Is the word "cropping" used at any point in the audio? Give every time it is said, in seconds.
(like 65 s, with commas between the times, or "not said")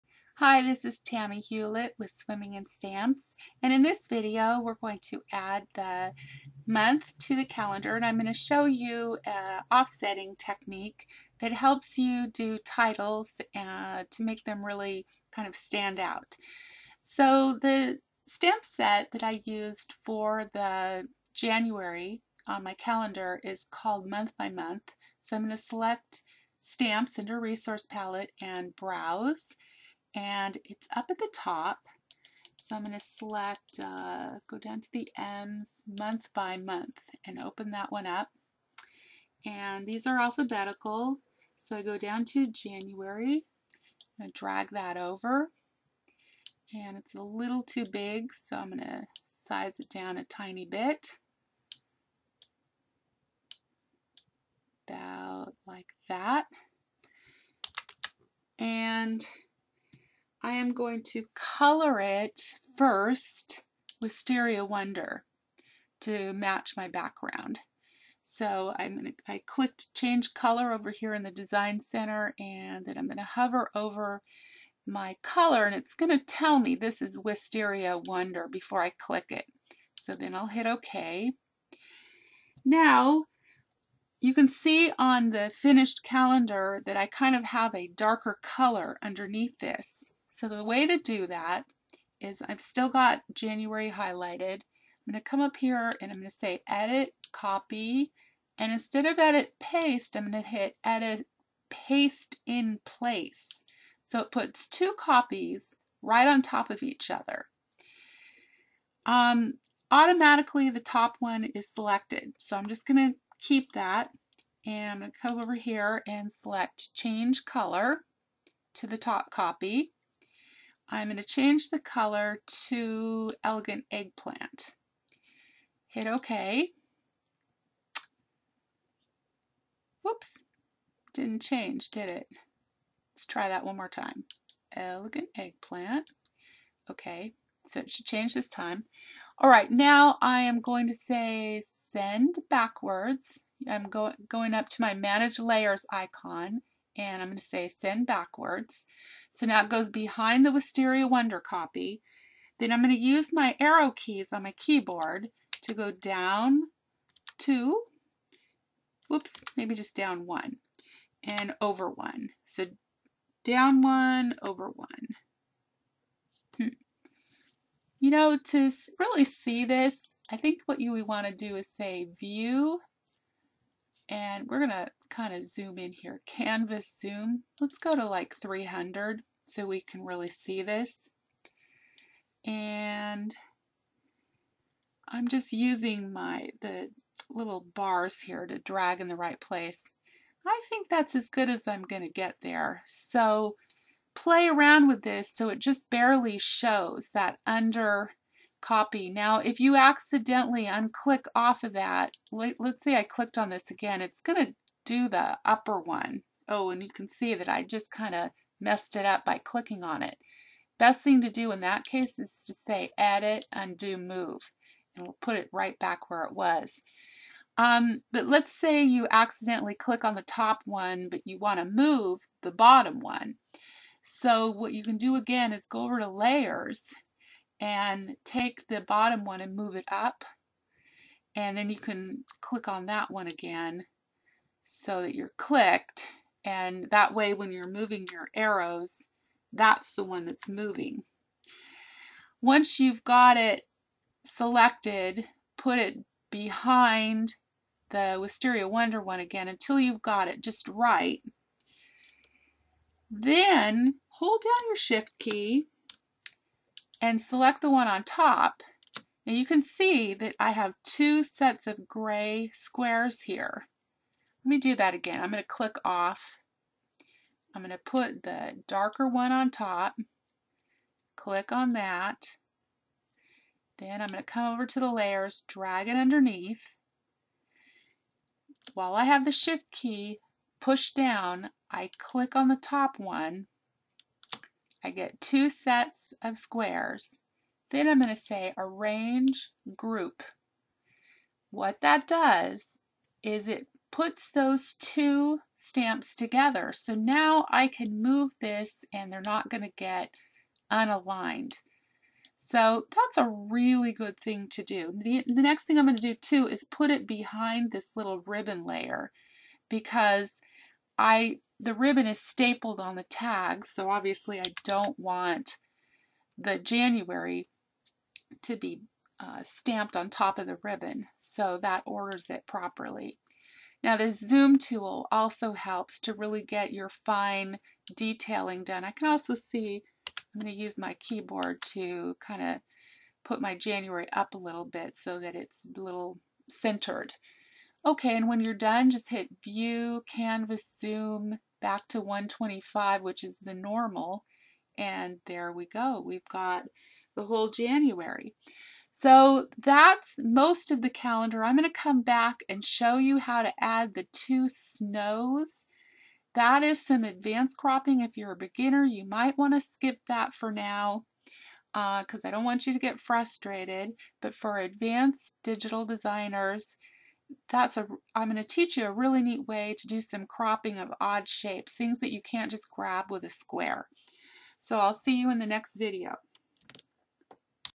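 357 s, 370 s.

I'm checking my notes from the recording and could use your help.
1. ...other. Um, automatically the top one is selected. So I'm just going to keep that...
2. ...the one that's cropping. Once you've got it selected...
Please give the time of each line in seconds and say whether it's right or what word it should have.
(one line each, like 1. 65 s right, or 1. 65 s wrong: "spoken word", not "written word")
1. 107 s right
2. 239 s wrong: "moving", not "cropping".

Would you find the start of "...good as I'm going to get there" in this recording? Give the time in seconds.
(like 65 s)
191 s.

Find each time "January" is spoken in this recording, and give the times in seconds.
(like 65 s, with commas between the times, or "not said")
21 s, 42 s, 93 s, 316 s, 333 s, 347 s.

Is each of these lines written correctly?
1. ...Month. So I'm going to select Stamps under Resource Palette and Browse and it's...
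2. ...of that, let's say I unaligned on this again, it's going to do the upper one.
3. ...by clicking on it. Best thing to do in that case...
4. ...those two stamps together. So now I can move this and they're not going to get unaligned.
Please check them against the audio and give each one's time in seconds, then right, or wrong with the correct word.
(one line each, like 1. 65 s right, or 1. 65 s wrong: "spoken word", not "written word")
1. 24 s right
2. 201 s wrong: "clicked", not "unaligned"
3. 209 s right
4. 294 s right.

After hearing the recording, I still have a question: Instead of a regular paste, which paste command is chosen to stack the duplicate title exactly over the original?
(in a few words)
paste in place.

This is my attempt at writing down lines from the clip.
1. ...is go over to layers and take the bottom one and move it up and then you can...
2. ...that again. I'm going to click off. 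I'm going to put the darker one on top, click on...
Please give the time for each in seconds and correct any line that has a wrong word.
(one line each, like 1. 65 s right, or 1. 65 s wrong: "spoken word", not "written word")
1. 225 s right
2. 264 s right.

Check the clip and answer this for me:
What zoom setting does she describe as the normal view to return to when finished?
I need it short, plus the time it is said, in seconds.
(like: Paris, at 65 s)
125, at 342 s.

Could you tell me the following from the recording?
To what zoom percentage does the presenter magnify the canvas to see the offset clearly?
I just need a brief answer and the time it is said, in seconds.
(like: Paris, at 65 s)
300, at 178 s.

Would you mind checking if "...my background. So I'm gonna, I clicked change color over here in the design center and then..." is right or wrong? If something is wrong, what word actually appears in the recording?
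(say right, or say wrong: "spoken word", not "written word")
right.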